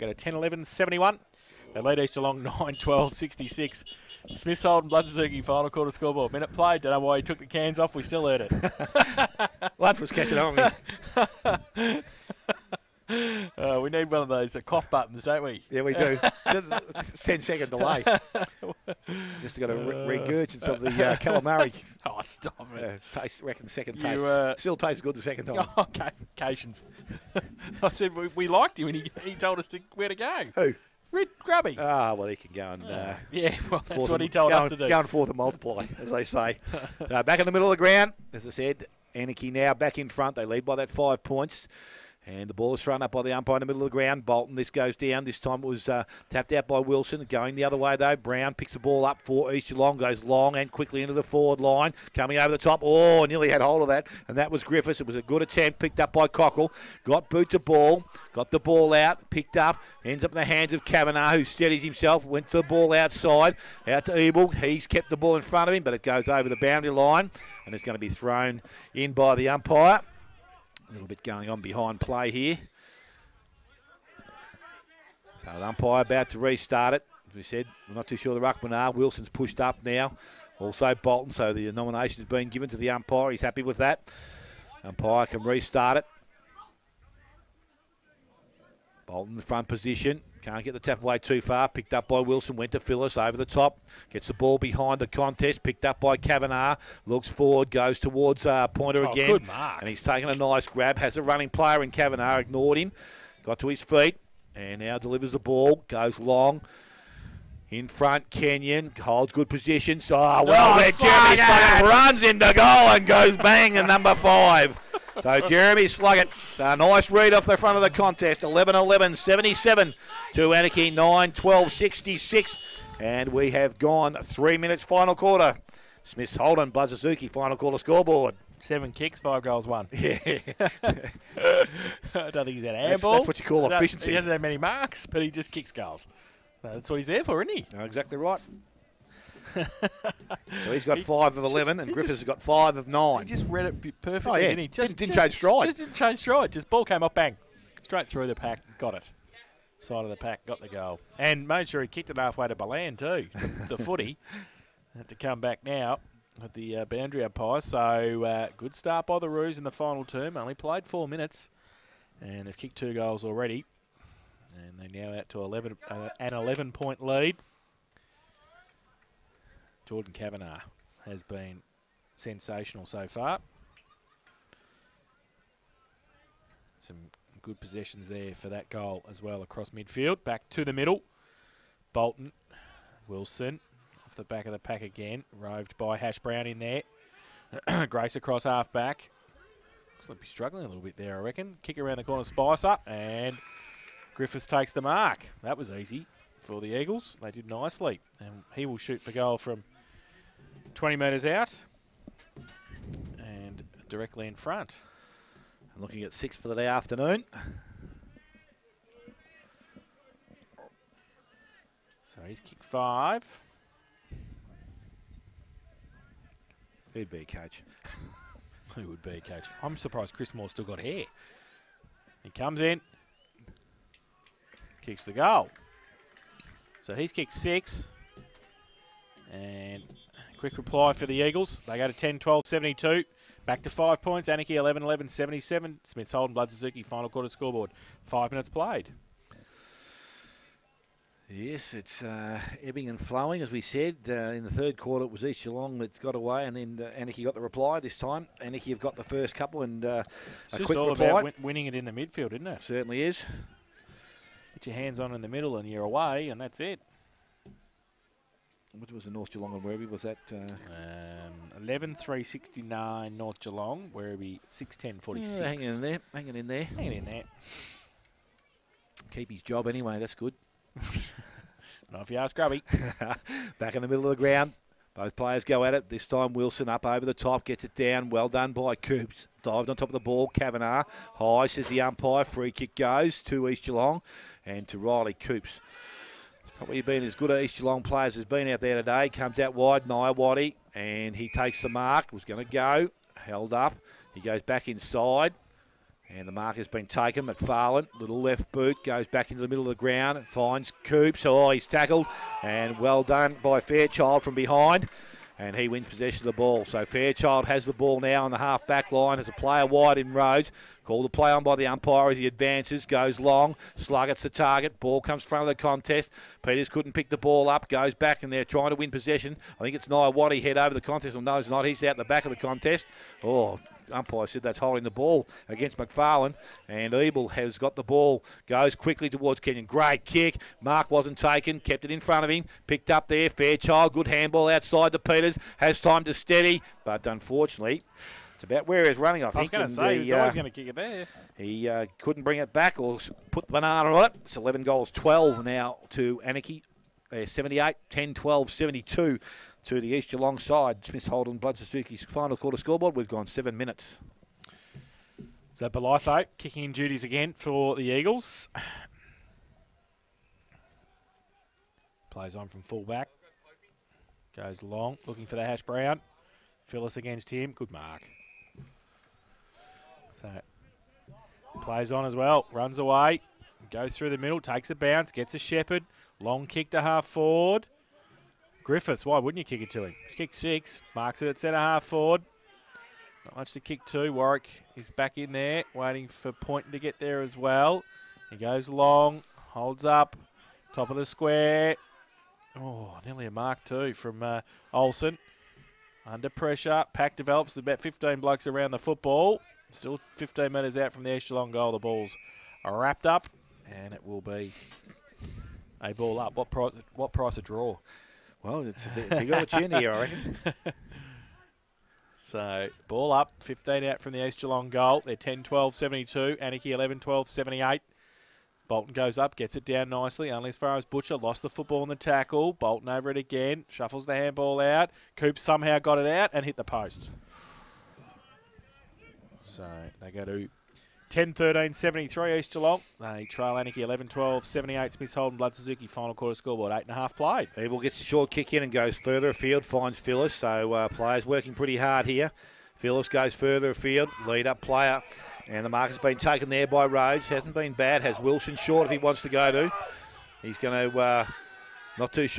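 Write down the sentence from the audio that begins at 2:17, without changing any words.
No, exactly right so he's got he five of 11, just, and Griffiths just, has got five of nine.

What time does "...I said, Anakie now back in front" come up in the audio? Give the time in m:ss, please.
0:38.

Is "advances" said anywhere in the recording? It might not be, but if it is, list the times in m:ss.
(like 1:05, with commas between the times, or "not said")
5:12.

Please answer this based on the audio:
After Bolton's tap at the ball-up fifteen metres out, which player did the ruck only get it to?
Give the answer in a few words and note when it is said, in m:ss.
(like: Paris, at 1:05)
Butcher, at 7:00.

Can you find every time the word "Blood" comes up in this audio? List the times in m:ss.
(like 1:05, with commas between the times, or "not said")
0:04, 0:09, 3:56, 5:51, 7:15.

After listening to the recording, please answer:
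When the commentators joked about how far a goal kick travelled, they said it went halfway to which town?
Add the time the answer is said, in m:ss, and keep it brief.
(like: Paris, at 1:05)
Ballan, at 2:32.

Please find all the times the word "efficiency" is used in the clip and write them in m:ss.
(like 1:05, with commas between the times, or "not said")
2:13.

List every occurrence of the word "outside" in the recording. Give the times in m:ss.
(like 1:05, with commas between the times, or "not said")
1:02, 5:34.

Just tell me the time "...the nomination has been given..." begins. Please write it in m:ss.
1:21.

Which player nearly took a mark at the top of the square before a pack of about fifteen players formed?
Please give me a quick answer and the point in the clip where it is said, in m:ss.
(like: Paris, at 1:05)
Olsen, at 6:34.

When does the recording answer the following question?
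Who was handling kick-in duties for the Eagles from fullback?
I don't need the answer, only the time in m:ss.
5:55.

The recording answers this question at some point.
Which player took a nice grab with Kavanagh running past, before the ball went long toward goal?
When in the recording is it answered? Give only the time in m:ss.
1:38.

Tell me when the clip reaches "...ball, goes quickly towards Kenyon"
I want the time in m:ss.
5:27.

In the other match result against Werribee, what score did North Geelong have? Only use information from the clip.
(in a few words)
11 3 69.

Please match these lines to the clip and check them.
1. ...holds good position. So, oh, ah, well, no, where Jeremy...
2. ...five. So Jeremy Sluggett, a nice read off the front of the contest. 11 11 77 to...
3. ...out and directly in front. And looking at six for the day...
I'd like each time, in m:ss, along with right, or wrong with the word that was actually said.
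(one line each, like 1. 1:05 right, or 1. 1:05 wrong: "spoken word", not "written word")
1. 1:49 right
2. 1:54 right
3. 3:21 right.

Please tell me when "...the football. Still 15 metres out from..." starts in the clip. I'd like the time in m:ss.
6:38.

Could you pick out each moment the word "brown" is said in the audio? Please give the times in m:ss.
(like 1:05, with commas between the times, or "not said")
0:48, 3:06, 6:05.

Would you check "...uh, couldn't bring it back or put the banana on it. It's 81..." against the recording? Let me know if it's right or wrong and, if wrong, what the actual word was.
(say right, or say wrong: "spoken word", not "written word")
wrong: "11", not "81".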